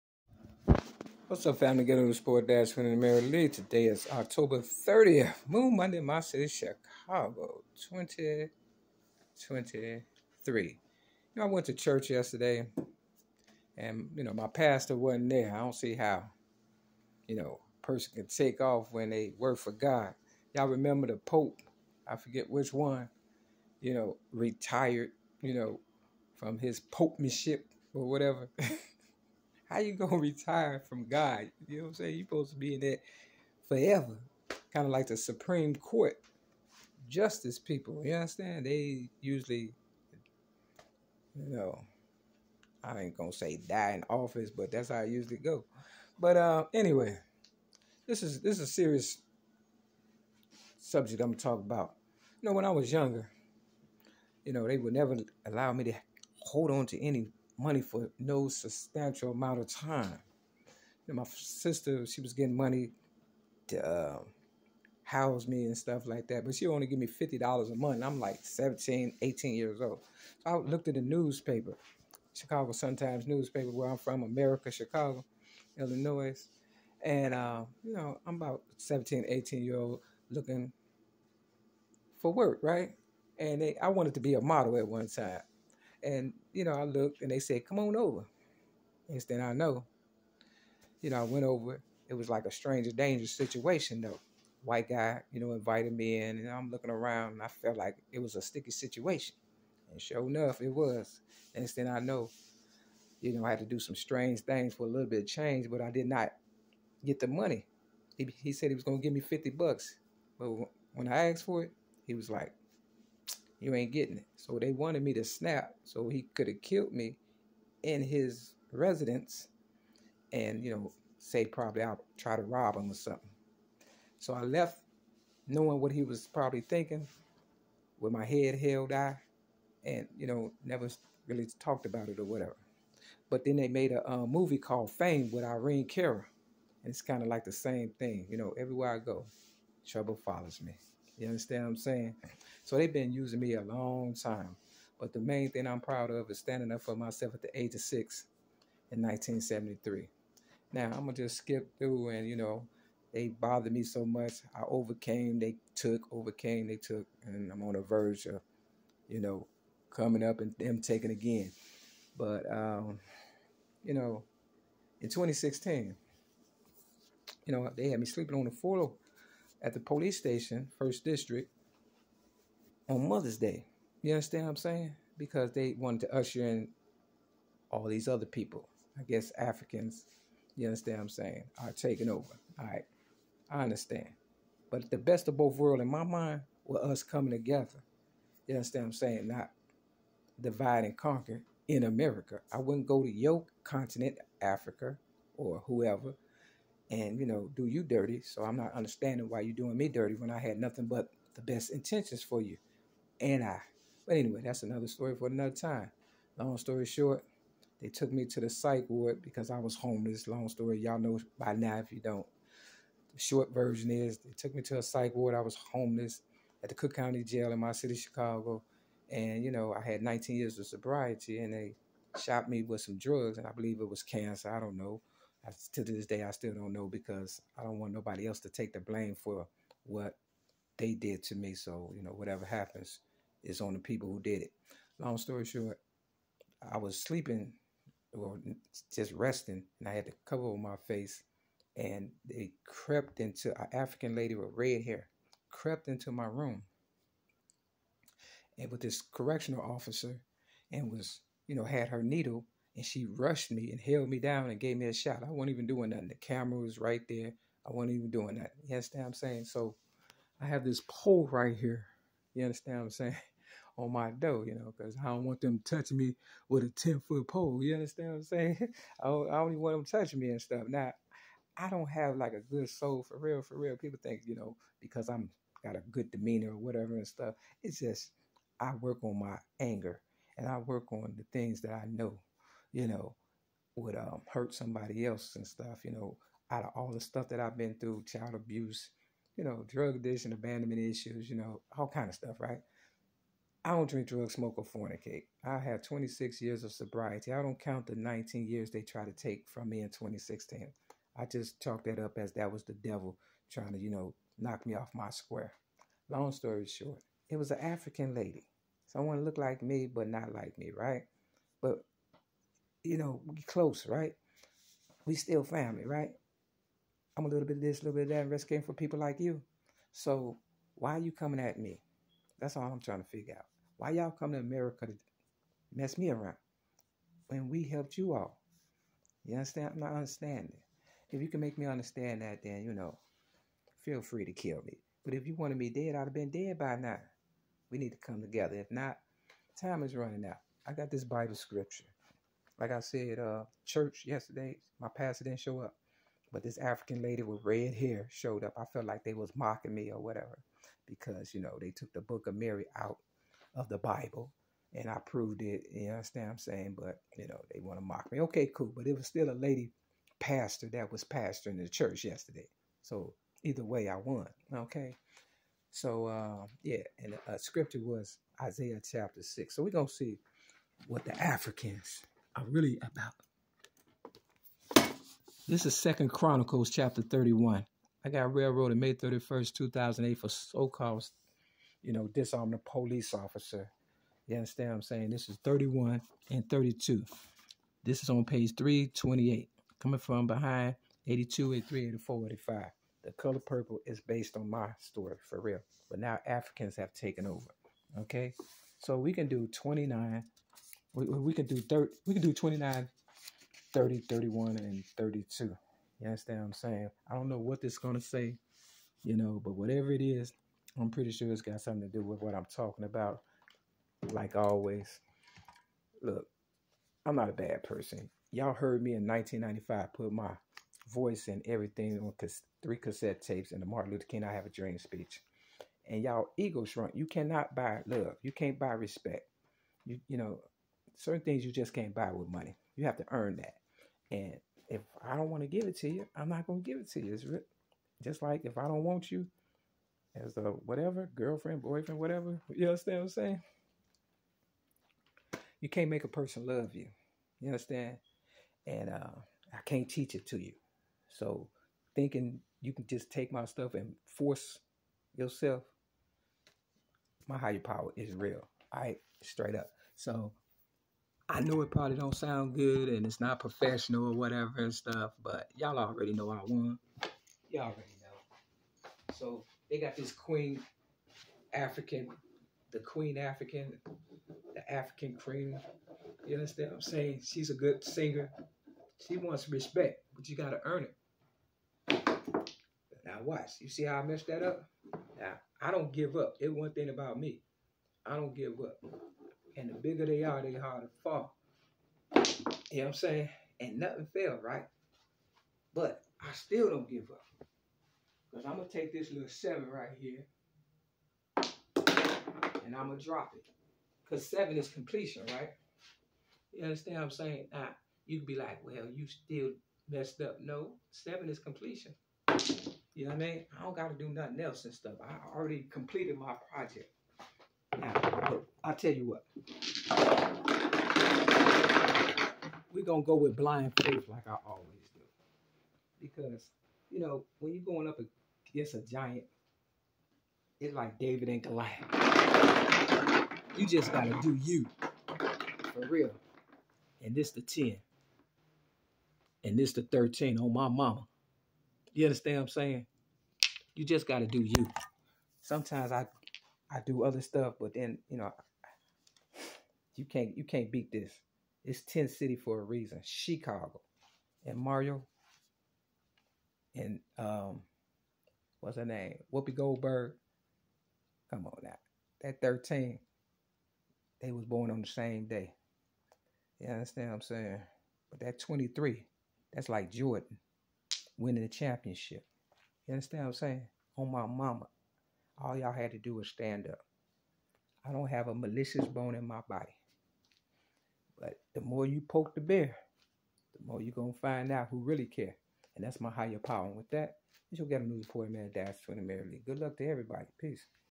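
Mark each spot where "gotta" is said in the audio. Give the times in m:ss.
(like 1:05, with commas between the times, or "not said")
8:00, 8:53, 9:04.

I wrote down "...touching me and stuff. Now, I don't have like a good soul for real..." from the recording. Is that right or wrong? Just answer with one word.
right.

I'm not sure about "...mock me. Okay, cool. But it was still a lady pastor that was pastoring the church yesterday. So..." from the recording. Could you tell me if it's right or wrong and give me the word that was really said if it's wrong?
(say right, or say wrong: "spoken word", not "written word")
right.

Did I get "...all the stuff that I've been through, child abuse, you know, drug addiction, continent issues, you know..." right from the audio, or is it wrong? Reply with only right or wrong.
wrong.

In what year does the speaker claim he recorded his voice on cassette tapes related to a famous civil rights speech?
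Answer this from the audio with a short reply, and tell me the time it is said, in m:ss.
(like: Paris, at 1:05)
1995, at 6:59.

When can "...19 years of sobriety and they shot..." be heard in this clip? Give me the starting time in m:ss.
3:40.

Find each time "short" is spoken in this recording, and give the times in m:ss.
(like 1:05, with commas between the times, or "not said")
3:26, 3:33, 3:55, 5:06.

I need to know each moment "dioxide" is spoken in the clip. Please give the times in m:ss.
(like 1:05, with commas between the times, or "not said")
not said.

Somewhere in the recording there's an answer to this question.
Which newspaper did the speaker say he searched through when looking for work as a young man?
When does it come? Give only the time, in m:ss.
1:12.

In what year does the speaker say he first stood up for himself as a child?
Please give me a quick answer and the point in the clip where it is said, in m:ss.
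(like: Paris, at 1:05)
1973, at 2:29.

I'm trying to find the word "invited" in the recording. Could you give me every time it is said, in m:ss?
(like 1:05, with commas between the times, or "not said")
1:35.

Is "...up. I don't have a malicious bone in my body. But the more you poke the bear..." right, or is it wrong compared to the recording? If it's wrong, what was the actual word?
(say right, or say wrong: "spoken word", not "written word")
right.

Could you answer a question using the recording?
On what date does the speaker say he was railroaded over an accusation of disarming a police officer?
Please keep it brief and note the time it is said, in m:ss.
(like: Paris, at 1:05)
May 31st, 2008, at 6:18.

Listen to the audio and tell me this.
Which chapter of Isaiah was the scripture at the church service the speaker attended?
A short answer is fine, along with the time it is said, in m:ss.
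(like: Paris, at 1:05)
chapter 6, at 6:08.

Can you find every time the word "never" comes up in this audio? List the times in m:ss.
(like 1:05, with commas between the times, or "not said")
0:54, 2:10.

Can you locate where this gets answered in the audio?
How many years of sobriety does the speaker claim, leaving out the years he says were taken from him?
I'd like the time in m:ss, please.
4:55.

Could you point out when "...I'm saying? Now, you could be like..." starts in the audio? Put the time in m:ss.
8:27.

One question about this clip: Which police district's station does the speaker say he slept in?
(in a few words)
first district.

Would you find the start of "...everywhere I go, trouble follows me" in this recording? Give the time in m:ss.
2:18.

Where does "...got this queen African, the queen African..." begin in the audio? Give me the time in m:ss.
7:49.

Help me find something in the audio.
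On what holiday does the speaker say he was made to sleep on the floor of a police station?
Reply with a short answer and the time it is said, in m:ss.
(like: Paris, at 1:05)
Mother's Day, at 2:53.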